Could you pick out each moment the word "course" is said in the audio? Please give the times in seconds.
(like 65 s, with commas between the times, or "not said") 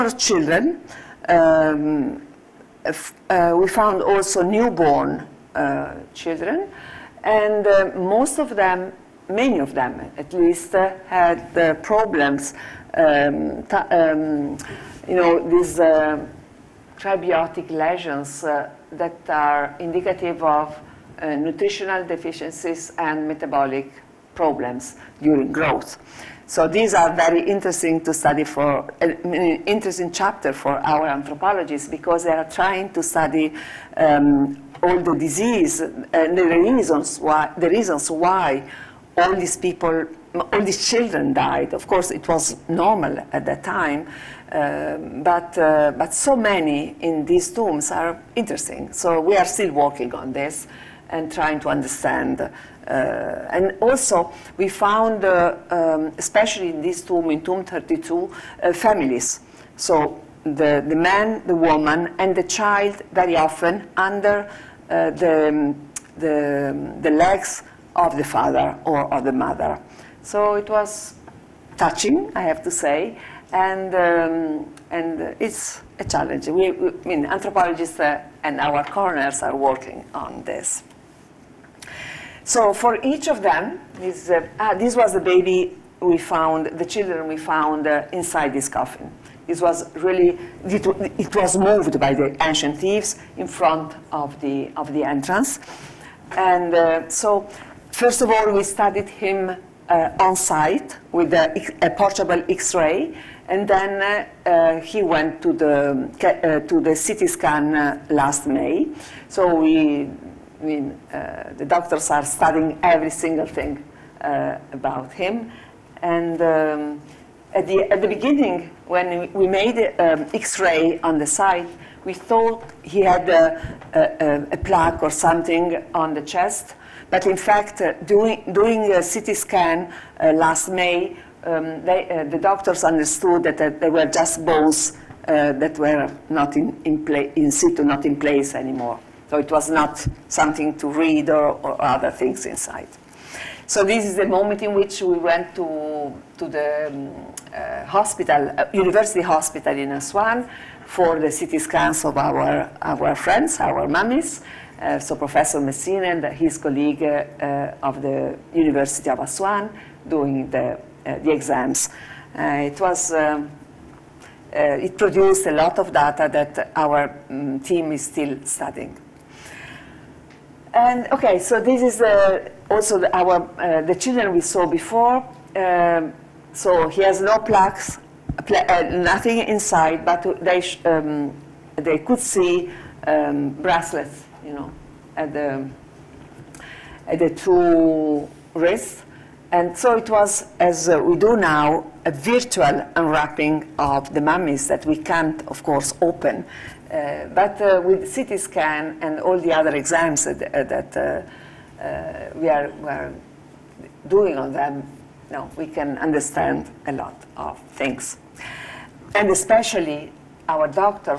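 41 s, 195 s.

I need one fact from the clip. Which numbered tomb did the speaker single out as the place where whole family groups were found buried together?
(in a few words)
Tomb 32.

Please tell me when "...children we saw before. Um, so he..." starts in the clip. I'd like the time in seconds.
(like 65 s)
173 s.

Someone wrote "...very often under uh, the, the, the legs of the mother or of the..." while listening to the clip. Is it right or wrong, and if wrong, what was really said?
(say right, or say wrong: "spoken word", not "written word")
wrong: "father", not "mother".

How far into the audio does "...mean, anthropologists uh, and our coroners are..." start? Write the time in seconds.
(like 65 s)
77 s.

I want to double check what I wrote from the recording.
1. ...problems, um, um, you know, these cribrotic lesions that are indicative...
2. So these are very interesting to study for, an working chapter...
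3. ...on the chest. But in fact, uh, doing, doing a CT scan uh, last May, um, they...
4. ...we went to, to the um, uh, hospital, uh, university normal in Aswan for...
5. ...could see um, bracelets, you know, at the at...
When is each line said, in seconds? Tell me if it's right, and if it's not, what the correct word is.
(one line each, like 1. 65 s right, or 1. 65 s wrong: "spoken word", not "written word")
1. 11 s right
2. 26 s wrong: "interesting", not "working"
3. 125 s right
4. 145 s wrong: "hospital", not "normal"
5. 181 s right.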